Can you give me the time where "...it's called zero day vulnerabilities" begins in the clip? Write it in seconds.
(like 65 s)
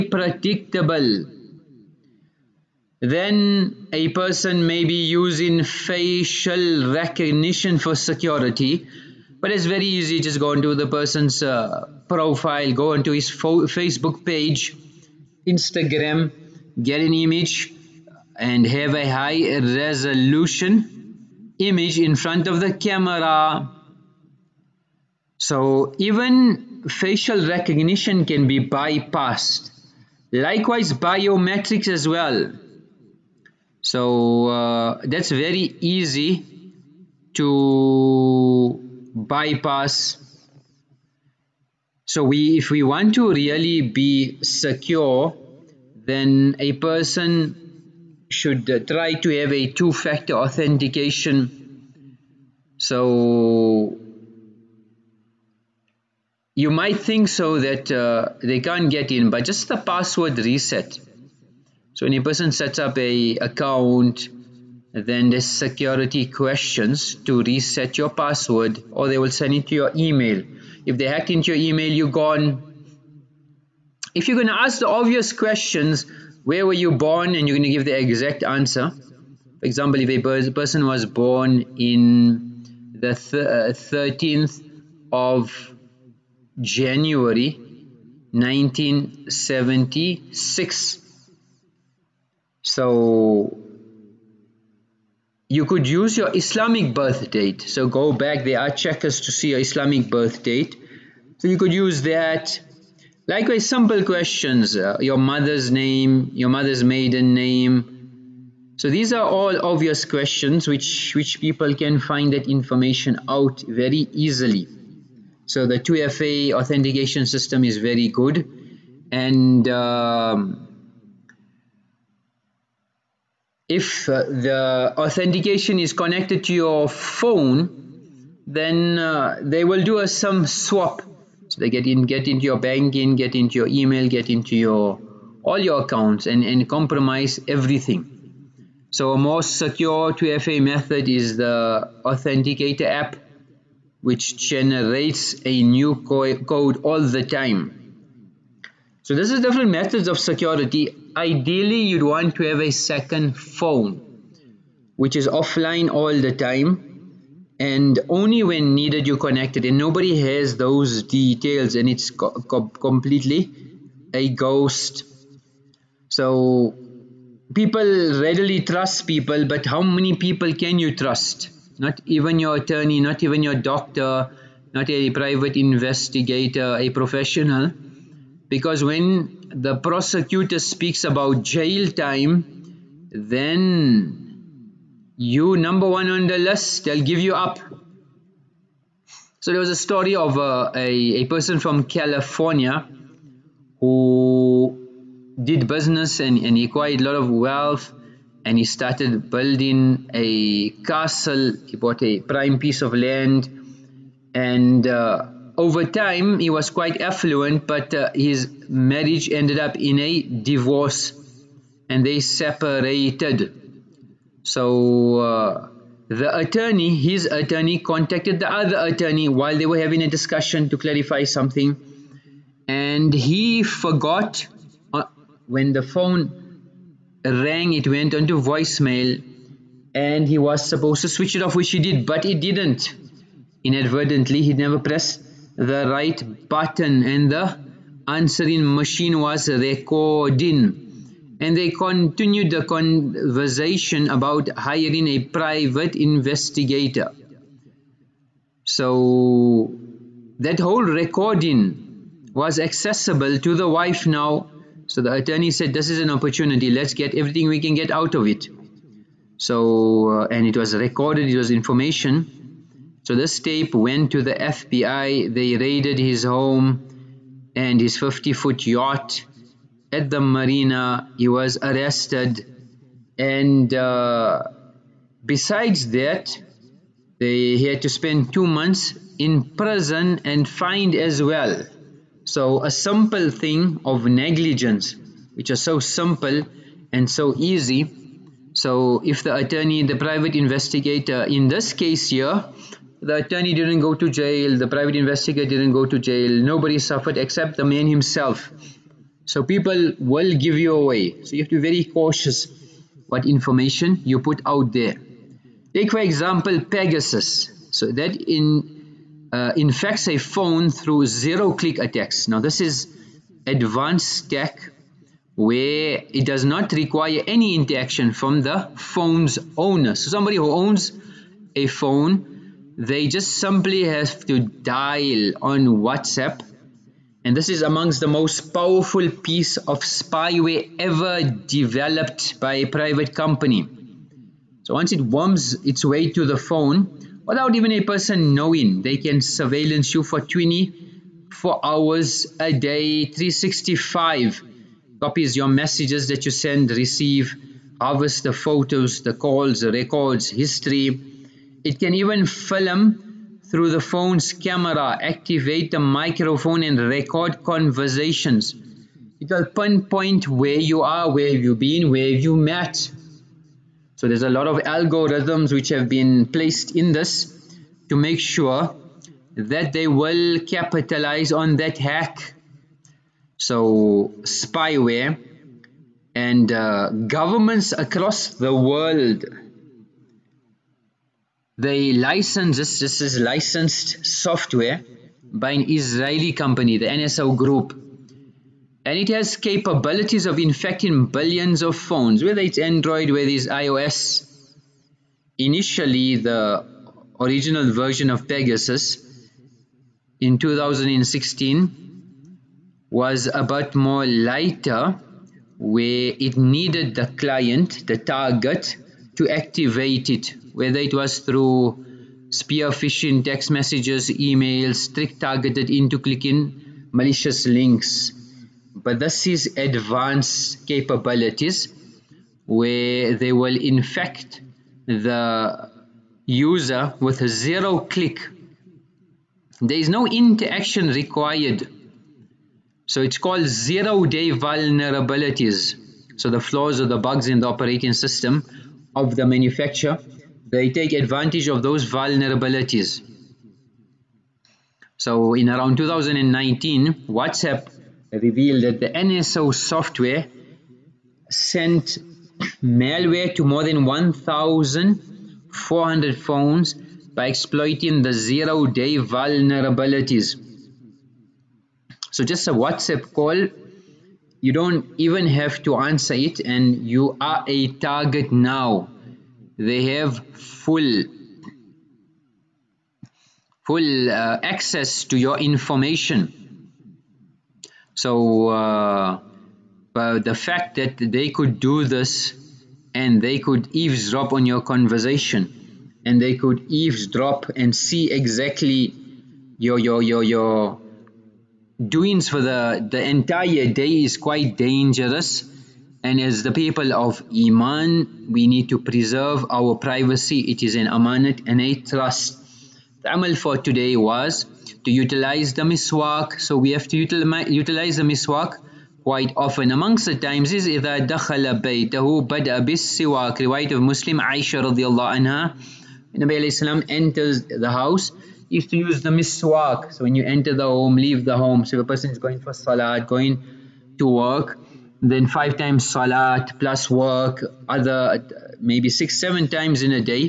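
433 s.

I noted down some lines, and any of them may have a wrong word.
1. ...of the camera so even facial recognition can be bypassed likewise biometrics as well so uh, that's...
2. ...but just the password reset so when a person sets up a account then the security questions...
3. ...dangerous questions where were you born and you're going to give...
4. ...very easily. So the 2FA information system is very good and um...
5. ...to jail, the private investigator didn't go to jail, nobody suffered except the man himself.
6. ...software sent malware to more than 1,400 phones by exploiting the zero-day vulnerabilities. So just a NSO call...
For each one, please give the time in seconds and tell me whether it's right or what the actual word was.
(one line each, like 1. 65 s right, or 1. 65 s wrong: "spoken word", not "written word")
1. 22 s right
2. 59 s right
3. 74 s wrong: "obvious", not "dangerous"
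4. 113 s wrong: "authentication", not "information"
5. 293 s right
6. 449 s wrong: "WhatsApp", not "NSO".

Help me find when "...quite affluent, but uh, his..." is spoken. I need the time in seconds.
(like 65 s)
206 s.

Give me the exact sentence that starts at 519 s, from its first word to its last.
So when you enter the home, leave the home.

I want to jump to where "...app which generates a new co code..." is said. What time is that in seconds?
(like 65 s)
142 s.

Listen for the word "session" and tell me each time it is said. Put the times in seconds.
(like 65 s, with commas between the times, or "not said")
not said.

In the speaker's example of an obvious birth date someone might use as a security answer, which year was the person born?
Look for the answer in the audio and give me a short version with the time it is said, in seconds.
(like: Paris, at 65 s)
1976, at 88 s.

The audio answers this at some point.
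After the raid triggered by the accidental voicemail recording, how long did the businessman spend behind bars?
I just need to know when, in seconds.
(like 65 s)
278 s.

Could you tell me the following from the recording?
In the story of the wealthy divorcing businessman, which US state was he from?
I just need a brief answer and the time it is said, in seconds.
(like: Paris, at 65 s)
California, at 191 s.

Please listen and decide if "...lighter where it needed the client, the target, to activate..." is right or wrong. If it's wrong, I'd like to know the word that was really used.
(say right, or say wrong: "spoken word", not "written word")
right.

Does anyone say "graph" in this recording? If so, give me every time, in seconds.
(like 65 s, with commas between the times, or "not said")
not said.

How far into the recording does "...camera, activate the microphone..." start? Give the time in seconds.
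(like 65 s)
354 s.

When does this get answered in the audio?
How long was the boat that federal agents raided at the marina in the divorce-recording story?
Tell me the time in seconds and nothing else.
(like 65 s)
267 s.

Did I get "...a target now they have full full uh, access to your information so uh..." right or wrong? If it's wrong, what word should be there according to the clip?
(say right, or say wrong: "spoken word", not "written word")
right.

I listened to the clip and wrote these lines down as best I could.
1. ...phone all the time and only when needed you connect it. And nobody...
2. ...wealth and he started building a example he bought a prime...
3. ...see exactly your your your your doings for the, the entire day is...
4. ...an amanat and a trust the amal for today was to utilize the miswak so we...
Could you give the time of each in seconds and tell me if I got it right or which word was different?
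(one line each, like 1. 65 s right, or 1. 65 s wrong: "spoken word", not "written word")
1. 155 s wrong: "offline", not "phone"
2. 197 s wrong: "castle", not "example"
3. 487 s right
4. 500 s right.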